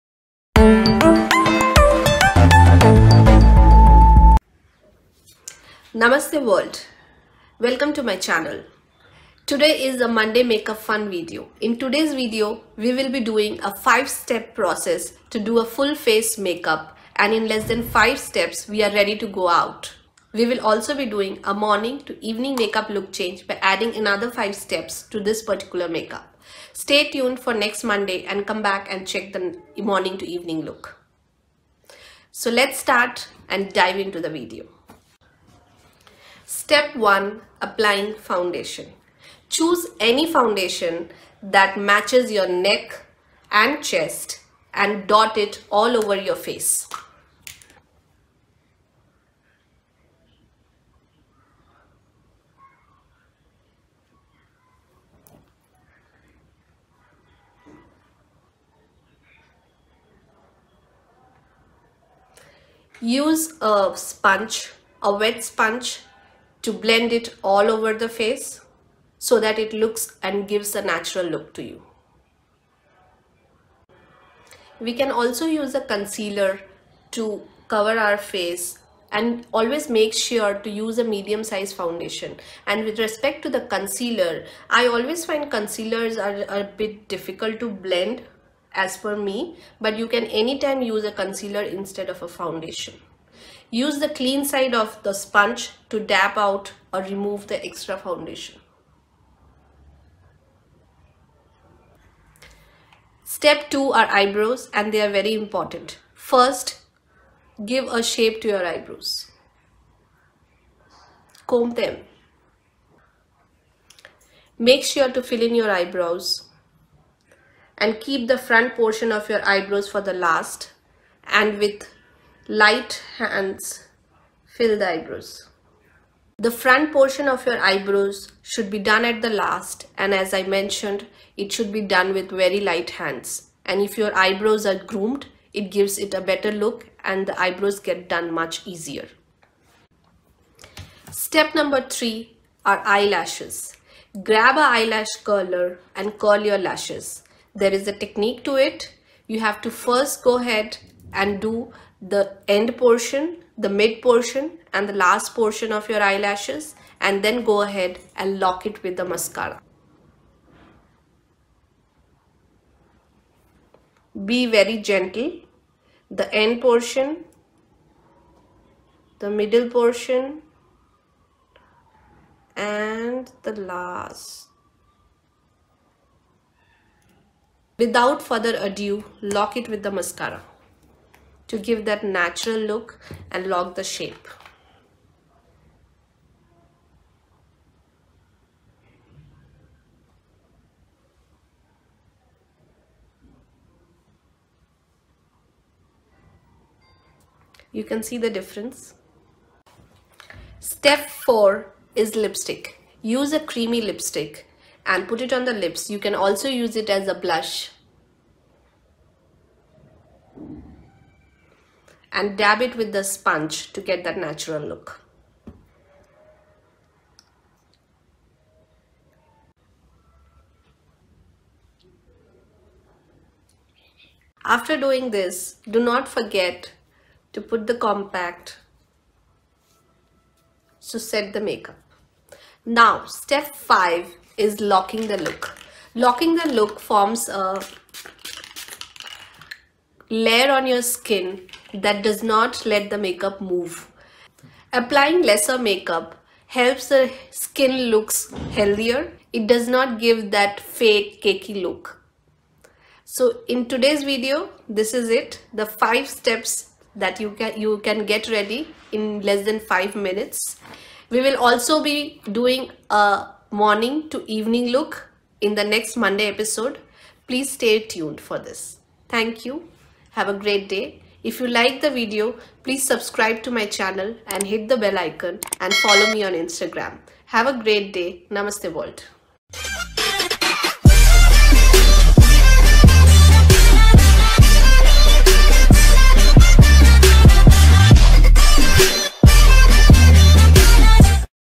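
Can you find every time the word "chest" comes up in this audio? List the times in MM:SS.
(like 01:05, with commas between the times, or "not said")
00:43.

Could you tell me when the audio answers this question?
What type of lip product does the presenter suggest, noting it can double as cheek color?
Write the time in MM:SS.
03:23.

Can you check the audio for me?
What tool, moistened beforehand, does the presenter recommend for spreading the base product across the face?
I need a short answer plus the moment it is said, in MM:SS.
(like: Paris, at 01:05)
wet sponge, at 01:05.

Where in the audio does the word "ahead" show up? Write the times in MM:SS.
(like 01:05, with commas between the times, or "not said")
02:30, 02:37.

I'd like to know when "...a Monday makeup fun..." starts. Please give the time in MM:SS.
00:09.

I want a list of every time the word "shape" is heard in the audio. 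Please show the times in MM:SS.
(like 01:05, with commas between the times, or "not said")
01:48, 03:03.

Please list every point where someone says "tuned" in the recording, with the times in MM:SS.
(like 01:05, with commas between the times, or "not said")
00:27, 04:27.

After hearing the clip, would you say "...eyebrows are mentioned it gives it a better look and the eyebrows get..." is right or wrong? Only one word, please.
wrong.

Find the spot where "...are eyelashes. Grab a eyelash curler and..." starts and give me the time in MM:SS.
02:22.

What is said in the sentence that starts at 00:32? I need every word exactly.
So let's start and dive into the video.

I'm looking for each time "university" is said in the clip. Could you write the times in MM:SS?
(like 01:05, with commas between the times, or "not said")
not said.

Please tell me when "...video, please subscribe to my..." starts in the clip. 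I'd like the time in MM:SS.
04:31.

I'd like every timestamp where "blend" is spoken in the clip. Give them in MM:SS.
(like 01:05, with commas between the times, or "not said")
01:06, 01:27.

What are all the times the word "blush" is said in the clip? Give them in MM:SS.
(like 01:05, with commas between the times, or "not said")
03:27.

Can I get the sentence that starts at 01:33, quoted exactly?
Use the clean side of the sponge to dab out or remove the extra foundation.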